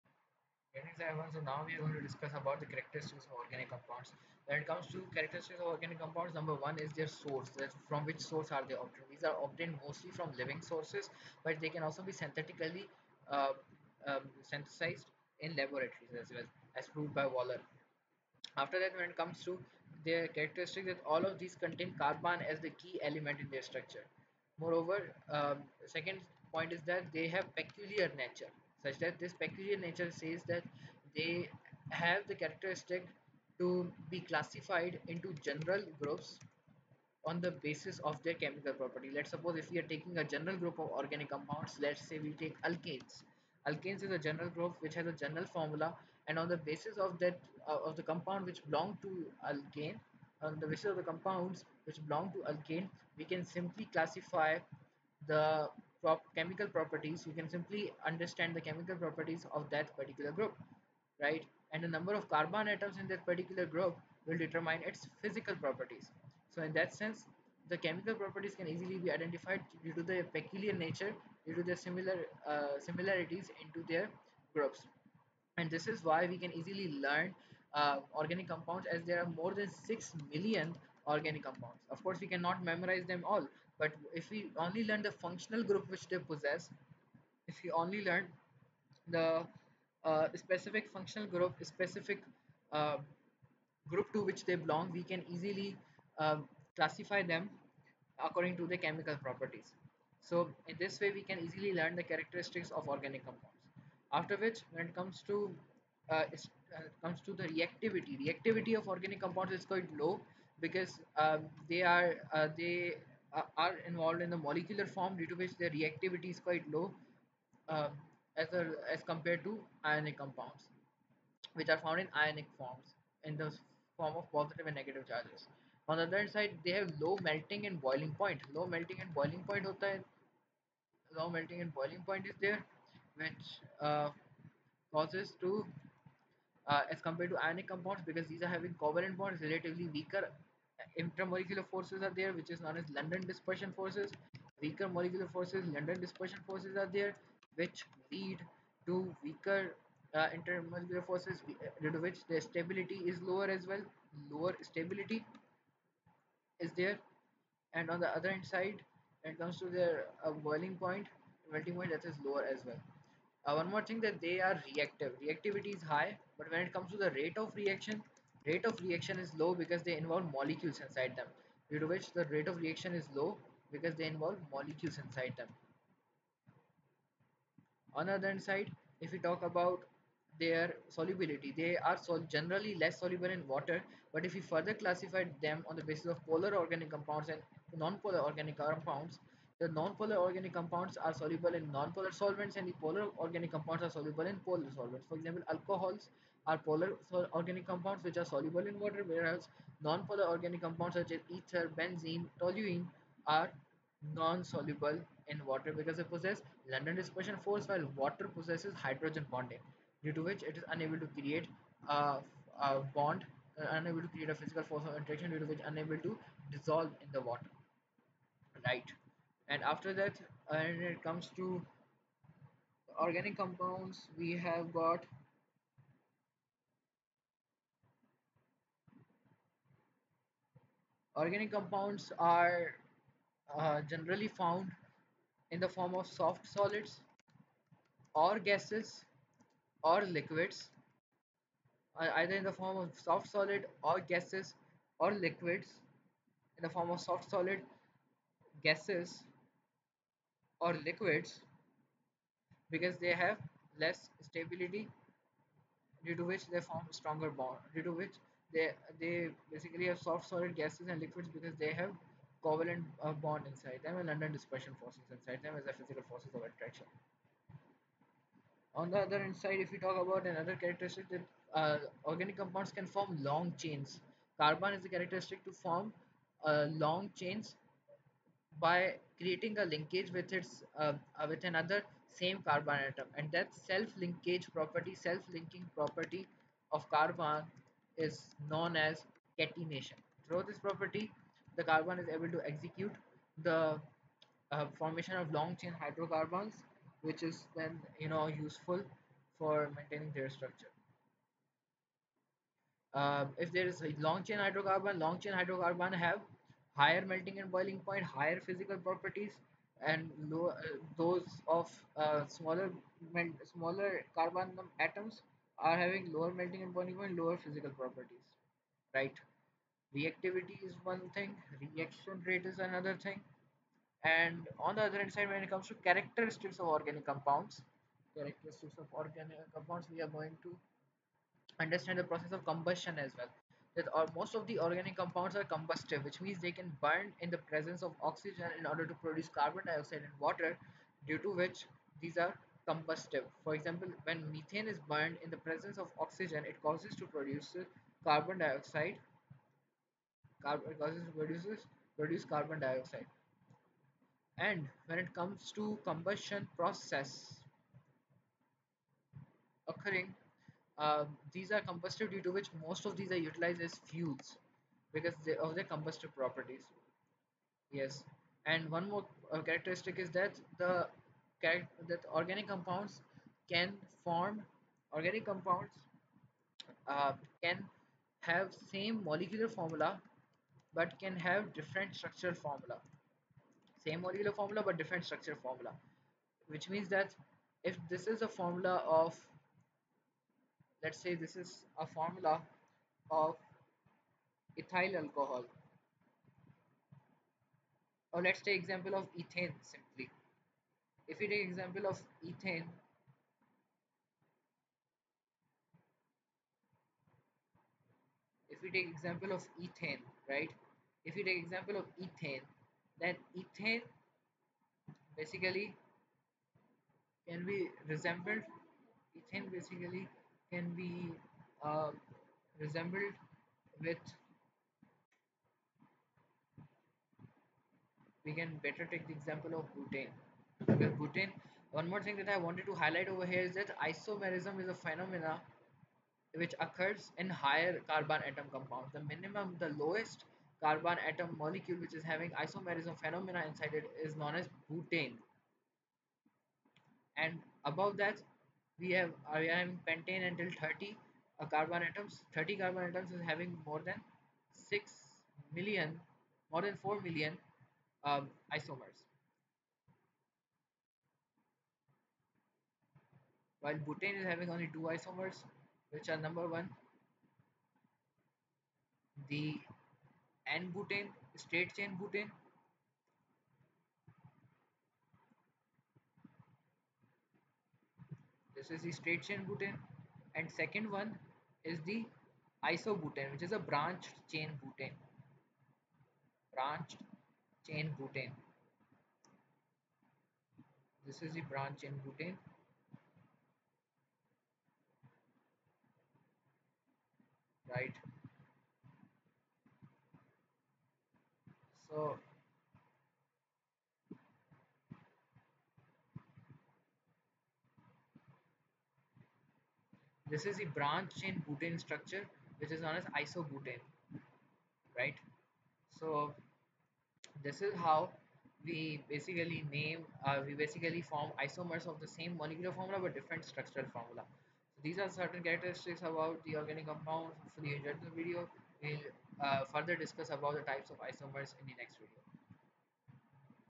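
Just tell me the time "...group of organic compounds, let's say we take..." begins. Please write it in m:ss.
0:40.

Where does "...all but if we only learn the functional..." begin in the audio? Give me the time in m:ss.
1:23.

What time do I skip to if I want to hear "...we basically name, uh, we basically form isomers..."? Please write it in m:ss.
8:38.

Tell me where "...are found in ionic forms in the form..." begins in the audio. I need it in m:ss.
2:01.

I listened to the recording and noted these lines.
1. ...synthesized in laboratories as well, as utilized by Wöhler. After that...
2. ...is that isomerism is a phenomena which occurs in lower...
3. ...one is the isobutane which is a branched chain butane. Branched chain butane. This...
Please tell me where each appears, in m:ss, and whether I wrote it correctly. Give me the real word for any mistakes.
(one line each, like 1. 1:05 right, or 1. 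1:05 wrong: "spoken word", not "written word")
1. 0:14 wrong: "proved", not "utilized"
2. 7:13 wrong: "higher", not "lower"
3. 8:00 right.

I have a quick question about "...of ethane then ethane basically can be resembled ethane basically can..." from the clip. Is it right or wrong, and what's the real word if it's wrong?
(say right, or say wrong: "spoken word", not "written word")
right.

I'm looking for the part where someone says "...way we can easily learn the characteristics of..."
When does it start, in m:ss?
1:40.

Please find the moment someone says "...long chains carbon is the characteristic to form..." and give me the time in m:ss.
4:33.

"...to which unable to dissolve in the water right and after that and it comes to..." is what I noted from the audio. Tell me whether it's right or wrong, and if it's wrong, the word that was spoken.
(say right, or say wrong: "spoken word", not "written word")
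right.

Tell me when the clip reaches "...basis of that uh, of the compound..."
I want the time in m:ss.
0:46.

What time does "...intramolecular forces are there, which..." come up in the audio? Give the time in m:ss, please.
2:20.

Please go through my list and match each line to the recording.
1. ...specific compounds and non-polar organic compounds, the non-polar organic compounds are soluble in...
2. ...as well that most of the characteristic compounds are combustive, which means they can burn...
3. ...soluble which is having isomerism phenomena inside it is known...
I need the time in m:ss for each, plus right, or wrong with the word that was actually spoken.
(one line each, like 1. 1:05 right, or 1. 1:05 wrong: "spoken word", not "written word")
1. 3:06 wrong: "organic", not "specific"
2. 5:33 wrong: "organic", not "characteristic"
3. 7:21 wrong: "molecule", not "soluble".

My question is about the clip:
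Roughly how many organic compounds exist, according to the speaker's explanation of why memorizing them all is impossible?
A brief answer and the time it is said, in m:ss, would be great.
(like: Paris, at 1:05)
More than 6 million, at 1:19.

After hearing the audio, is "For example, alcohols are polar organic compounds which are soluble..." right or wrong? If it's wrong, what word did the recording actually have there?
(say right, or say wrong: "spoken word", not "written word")
right.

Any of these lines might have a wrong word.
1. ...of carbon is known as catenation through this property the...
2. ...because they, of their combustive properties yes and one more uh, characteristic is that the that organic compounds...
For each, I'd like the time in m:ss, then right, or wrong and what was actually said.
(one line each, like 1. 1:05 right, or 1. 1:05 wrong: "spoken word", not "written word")
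1. 4:46 right
2. 6:04 right.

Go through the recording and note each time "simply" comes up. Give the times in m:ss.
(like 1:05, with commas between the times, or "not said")
0:53, 0:57, 6:39.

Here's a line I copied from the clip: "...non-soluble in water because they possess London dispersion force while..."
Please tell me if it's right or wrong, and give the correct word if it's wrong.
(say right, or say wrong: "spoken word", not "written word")
right.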